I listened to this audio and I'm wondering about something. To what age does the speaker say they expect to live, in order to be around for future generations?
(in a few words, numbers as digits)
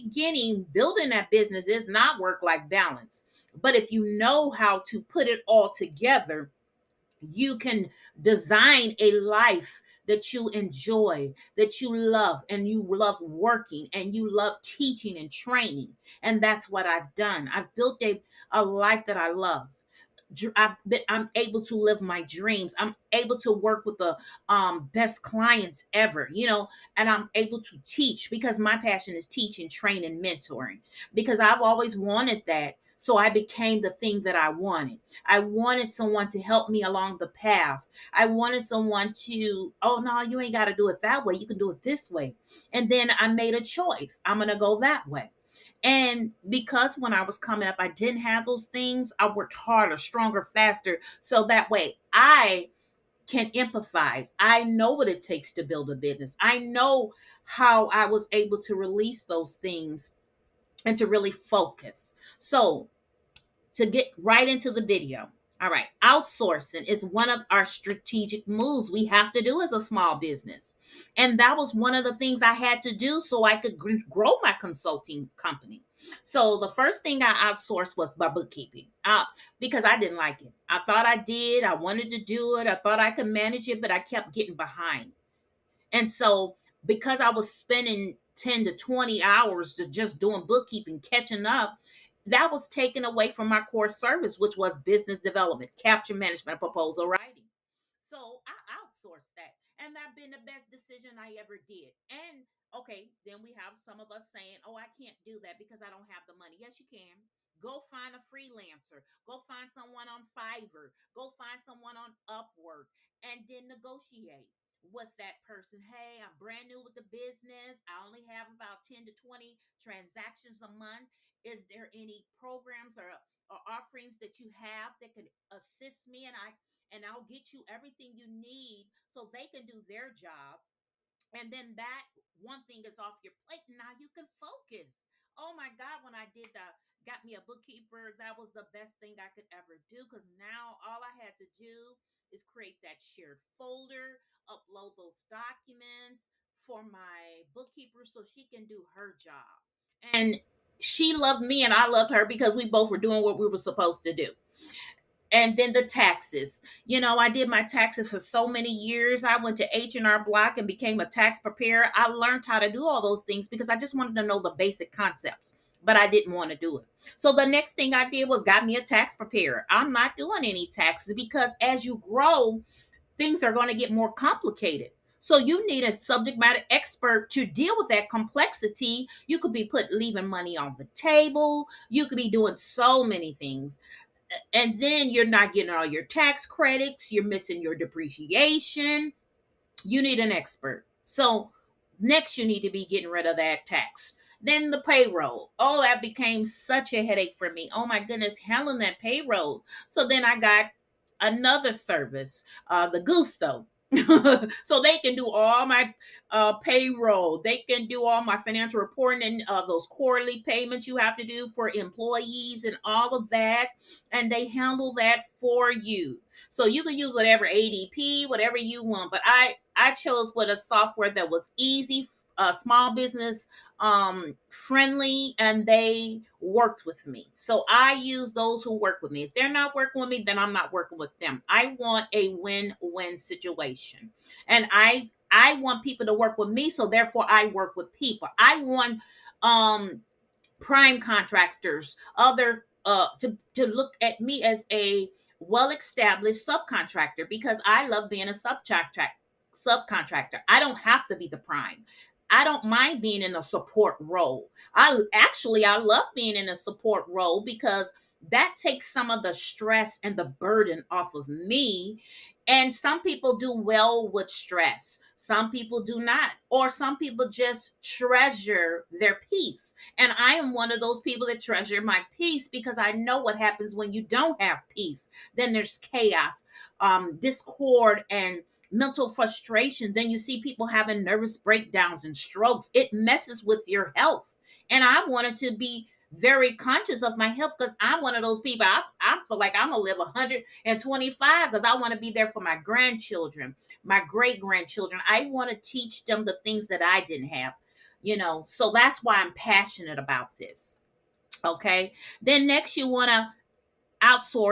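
125.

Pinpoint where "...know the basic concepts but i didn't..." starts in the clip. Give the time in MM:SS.
02:44.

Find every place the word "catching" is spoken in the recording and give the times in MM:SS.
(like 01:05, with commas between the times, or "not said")
01:30.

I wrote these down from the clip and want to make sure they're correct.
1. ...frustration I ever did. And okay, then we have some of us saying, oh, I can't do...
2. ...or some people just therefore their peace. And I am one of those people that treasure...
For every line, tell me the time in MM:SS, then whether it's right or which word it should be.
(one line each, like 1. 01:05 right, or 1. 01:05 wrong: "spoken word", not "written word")
1. 01:40 wrong: "decision", not "frustration"
2. 04:26 wrong: "treasure", not "therefore".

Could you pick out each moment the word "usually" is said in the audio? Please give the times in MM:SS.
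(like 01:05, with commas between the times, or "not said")
not said.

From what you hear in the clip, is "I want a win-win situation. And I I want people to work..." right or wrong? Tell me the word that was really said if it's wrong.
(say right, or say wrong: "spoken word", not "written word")
right.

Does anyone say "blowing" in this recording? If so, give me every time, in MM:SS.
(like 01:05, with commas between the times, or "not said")
not said.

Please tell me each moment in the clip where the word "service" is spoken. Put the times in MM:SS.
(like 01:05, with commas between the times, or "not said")
01:33, 03:21.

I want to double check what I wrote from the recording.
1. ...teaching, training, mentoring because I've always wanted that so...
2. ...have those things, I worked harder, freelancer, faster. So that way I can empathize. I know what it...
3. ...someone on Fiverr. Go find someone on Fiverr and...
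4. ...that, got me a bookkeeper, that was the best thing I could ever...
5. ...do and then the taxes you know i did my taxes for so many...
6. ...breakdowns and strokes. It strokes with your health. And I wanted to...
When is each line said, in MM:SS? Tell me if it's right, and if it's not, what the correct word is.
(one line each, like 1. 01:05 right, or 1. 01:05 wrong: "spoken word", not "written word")
1. 00:29 right
2. 00:48 wrong: "stronger", not "freelancer"
3. 01:49 wrong: "Upwork", not "Fiverr"
4. 02:16 right
5. 02:34 right
6. 04:41 wrong: "messes", not "strokes".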